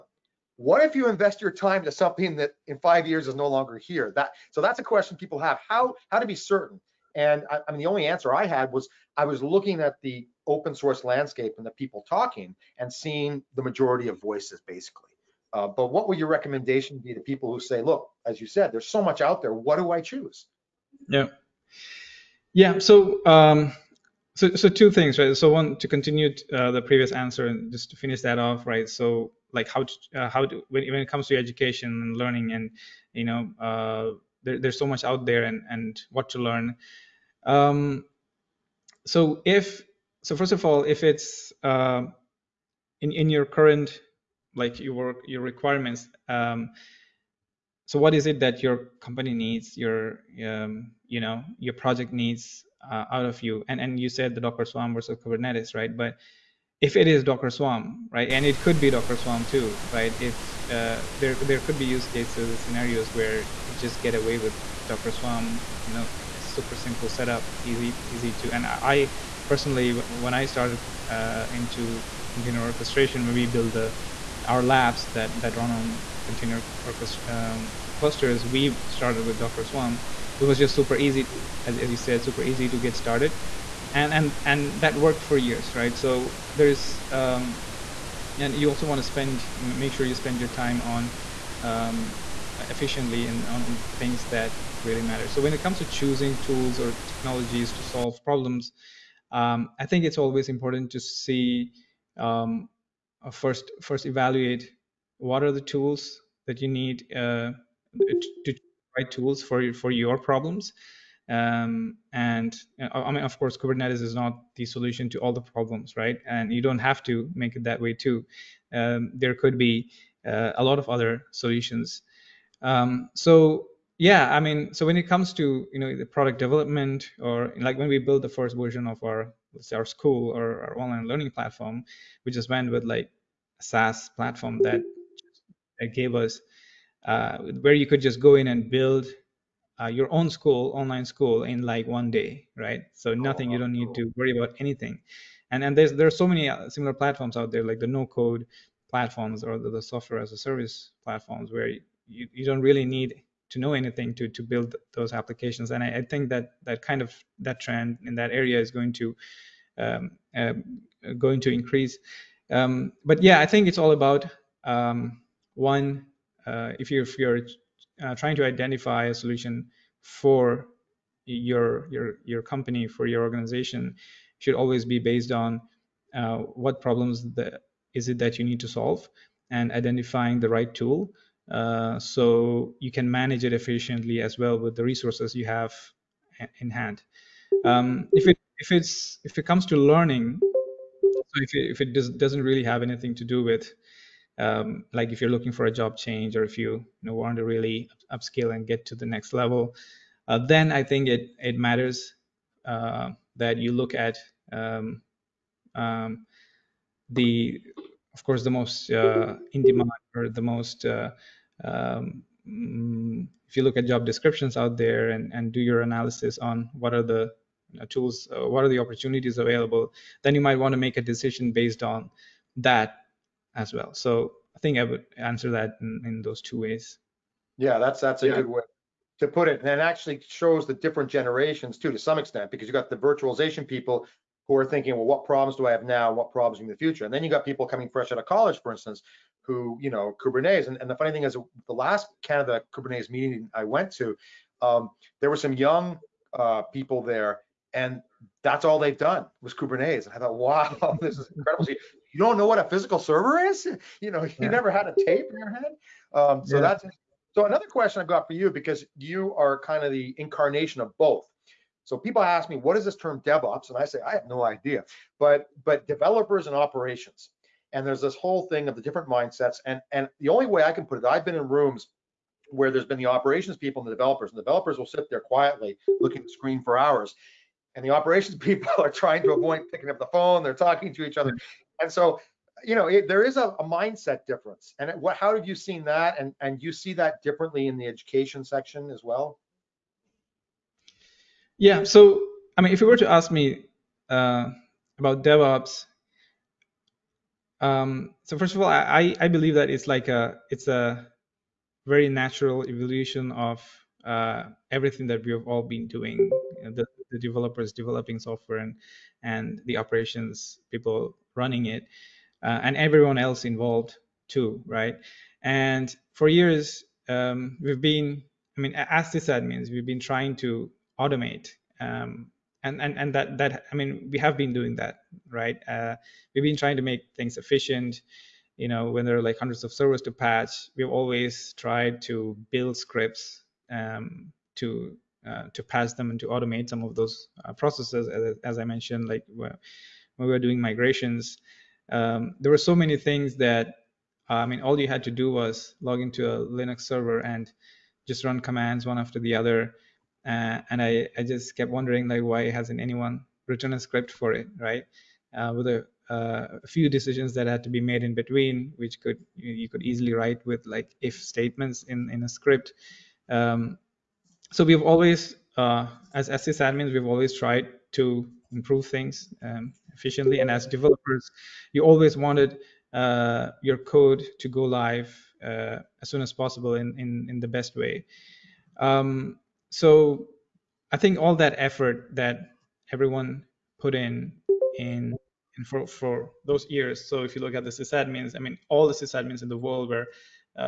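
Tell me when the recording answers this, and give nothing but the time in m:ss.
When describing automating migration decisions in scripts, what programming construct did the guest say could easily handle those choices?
6:01.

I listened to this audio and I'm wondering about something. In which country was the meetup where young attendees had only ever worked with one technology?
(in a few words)
Canada.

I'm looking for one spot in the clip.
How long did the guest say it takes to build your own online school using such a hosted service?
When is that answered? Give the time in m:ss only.
2:21.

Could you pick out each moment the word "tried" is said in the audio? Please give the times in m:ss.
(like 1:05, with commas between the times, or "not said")
5:31, 6:07.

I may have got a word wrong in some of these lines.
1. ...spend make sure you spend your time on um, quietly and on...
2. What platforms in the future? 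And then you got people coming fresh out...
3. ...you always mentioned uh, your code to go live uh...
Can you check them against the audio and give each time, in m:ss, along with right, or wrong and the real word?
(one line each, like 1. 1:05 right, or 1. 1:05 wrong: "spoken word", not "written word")
1. 1:29 wrong: "efficiently", not "quietly"
2. 3:56 wrong: "problems", not "platforms"
3. 6:11 wrong: "wanted", not "mentioned".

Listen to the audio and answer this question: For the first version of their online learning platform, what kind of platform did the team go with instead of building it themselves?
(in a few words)
SaaS platform.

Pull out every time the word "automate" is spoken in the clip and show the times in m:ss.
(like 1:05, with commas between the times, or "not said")
5:20, 5:36.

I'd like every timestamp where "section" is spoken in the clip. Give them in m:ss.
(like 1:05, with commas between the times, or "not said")
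4:48.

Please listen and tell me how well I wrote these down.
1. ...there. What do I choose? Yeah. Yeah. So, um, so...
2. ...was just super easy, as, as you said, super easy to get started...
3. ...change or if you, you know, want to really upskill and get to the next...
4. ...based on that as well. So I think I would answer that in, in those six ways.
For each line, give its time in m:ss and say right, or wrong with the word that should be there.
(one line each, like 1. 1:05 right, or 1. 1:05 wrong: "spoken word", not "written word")
1. 0:19 right
2. 1:20 right
3. 3:15 right
4. 3:41 wrong: "two", not "six".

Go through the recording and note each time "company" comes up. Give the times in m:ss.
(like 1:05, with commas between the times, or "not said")
0:49, 2:52.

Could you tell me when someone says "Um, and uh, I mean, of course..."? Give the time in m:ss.
1:51.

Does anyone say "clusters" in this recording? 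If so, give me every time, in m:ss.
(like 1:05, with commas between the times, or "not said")
1:17.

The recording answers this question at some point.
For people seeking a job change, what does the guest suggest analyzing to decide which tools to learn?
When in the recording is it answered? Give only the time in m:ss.
3:33.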